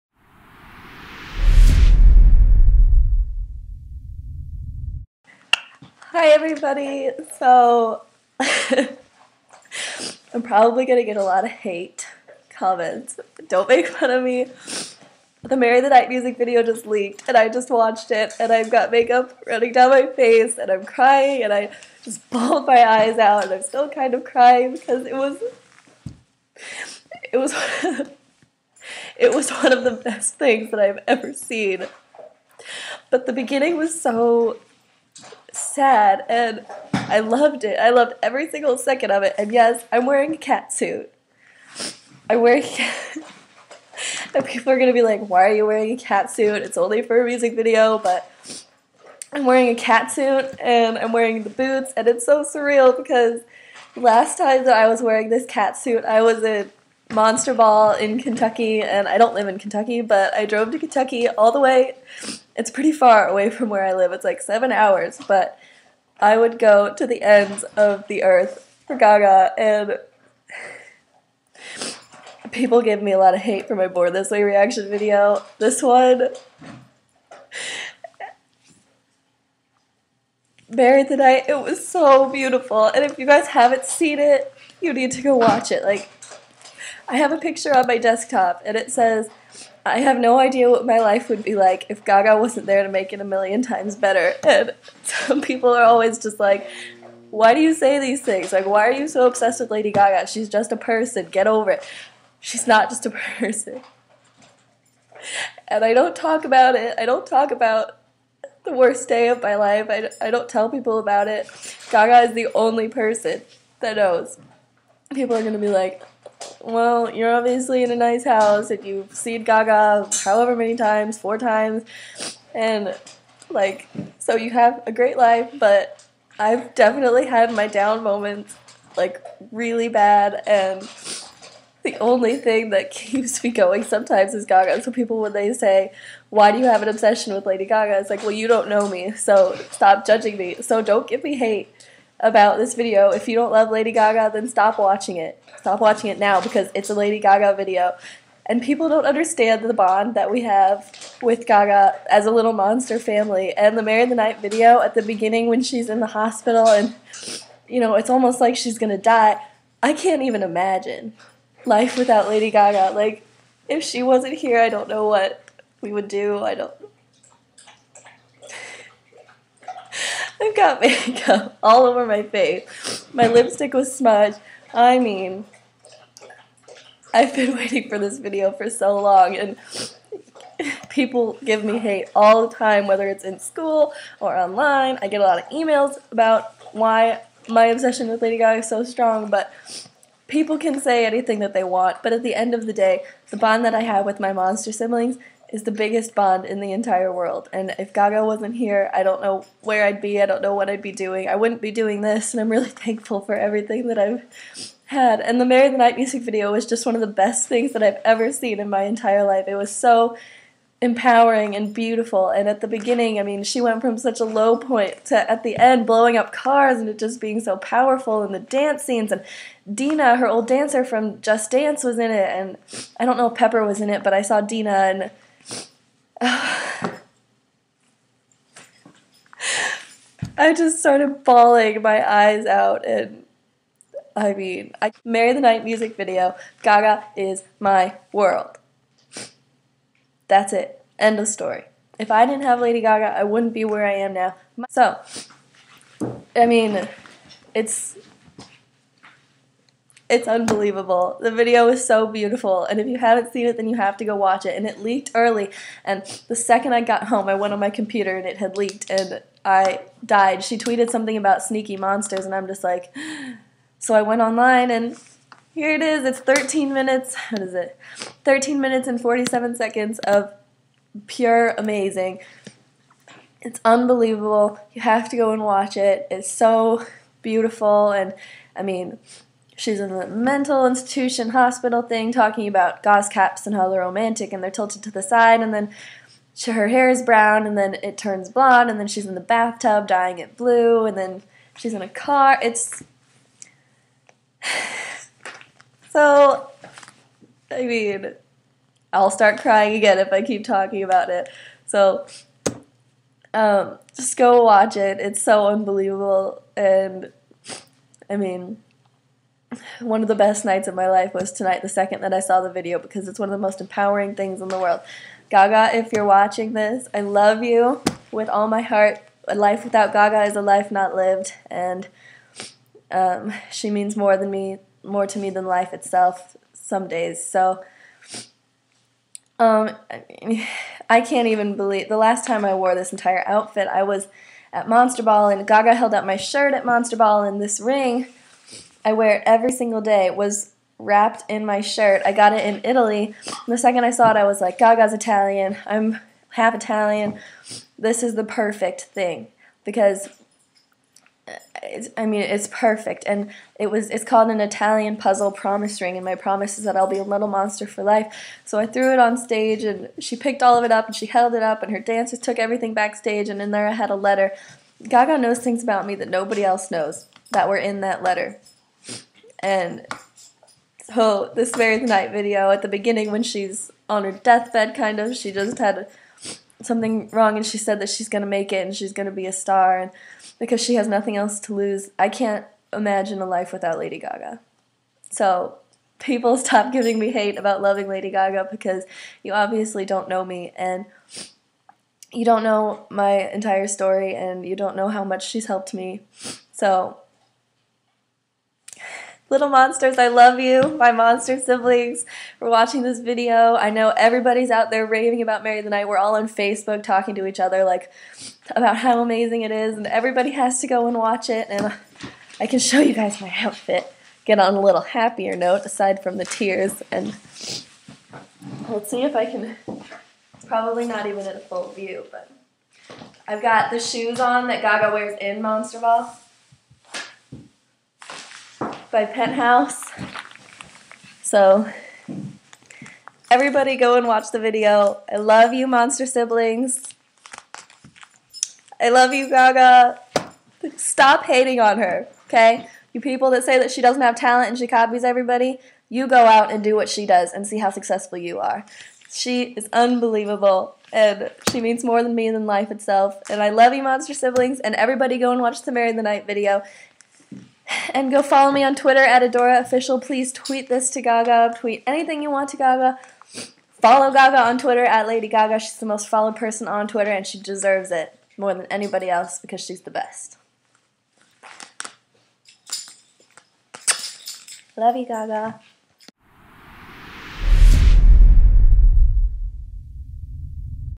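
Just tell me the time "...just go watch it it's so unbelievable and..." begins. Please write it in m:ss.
5:03.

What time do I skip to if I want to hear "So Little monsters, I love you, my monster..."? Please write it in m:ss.
6:36.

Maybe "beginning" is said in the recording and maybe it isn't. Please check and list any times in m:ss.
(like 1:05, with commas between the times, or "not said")
0:33, 2:35, 3:32, 6:12.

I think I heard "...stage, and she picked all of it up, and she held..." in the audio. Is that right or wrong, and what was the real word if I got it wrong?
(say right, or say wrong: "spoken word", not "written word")
right.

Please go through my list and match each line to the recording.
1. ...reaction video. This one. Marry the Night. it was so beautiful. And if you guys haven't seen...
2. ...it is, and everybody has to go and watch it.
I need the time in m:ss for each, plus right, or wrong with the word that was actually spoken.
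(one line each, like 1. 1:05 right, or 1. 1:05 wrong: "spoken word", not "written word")
1. 1:14 right
2. 6:49 right.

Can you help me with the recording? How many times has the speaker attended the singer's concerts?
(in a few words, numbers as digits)
4 times.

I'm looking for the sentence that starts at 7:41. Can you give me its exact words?
Tweet anything you want to Gaga.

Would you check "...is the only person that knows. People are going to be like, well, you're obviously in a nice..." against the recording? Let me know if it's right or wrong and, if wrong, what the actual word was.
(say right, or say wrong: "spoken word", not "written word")
right.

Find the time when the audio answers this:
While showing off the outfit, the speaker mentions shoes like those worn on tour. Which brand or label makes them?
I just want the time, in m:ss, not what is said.
7:09.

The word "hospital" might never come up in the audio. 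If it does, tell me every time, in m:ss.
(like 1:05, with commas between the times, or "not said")
2:36, 4:41.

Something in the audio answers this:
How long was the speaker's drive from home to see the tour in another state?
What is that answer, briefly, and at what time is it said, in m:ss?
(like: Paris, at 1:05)
7 hours, at 1:04.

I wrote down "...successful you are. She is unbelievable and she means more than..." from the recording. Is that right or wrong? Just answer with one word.
right.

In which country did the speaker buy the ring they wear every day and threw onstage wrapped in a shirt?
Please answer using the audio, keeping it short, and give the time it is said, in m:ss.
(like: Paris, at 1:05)
Italy, at 5:42.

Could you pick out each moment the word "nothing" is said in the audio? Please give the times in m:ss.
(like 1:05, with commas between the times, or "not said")
6:20.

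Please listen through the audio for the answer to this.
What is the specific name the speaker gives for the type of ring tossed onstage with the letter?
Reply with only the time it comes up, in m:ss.
5:54.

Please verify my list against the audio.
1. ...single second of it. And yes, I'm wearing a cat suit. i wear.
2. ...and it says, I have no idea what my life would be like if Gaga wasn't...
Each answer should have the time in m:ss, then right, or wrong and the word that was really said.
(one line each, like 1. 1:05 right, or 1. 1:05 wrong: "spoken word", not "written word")
1. 0:38 right
2. 1:28 right.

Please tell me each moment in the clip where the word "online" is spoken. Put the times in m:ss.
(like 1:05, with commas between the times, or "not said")
3:04, 4:24.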